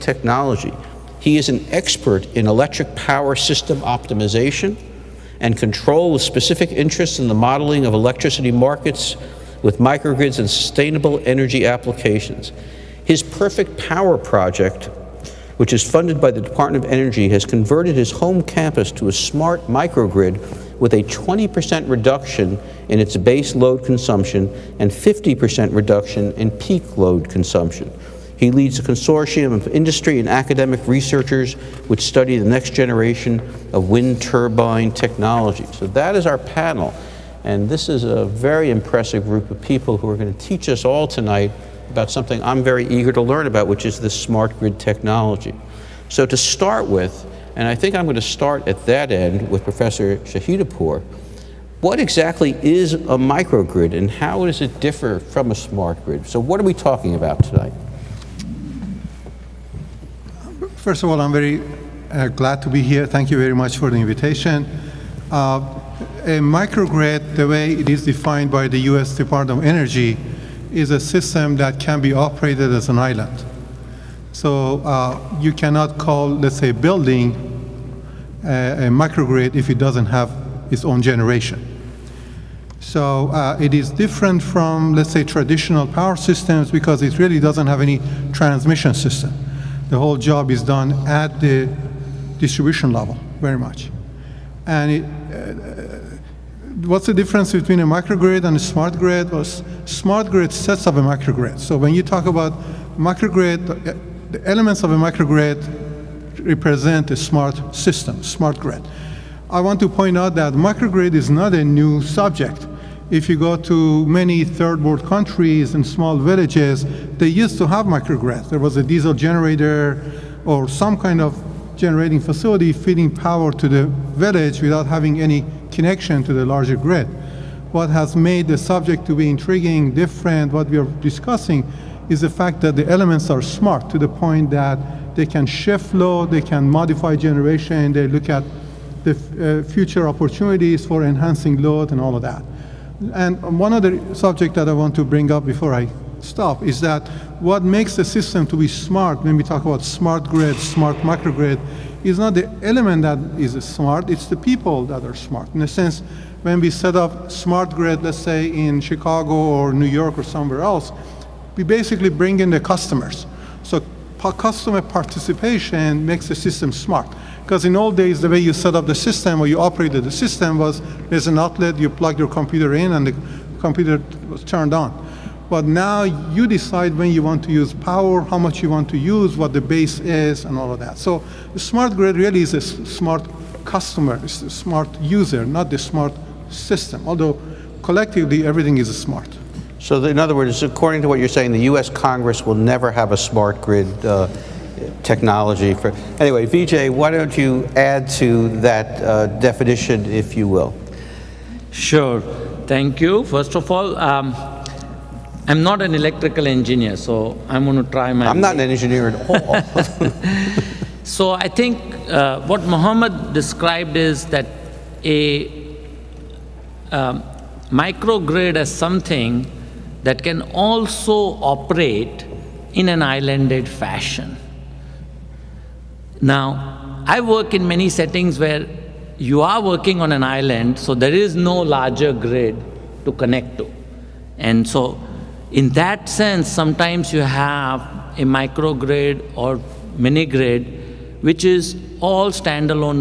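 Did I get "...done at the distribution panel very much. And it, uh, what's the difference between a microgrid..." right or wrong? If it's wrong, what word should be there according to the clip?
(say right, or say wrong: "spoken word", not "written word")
wrong: "level", not "panel".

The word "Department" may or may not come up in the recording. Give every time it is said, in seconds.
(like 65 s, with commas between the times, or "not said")
16 s, 69 s.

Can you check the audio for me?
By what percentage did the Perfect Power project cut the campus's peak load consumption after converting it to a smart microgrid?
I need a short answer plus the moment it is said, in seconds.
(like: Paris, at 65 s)
50%, at 24 s.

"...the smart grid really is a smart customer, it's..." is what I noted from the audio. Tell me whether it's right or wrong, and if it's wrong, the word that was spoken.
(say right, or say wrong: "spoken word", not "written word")
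right.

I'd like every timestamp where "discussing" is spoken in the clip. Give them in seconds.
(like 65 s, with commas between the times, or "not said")
131 s.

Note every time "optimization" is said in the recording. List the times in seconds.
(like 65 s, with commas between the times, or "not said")
3 s.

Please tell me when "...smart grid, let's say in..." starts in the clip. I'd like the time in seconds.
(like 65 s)
157 s.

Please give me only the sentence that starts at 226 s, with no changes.
Now, I work in many settings where you are working on an island, so there is no larger grid to connect to.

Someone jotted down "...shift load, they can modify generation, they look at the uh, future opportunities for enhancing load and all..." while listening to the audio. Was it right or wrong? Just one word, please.
right.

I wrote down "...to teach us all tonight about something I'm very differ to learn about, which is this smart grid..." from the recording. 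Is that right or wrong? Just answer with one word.
wrong.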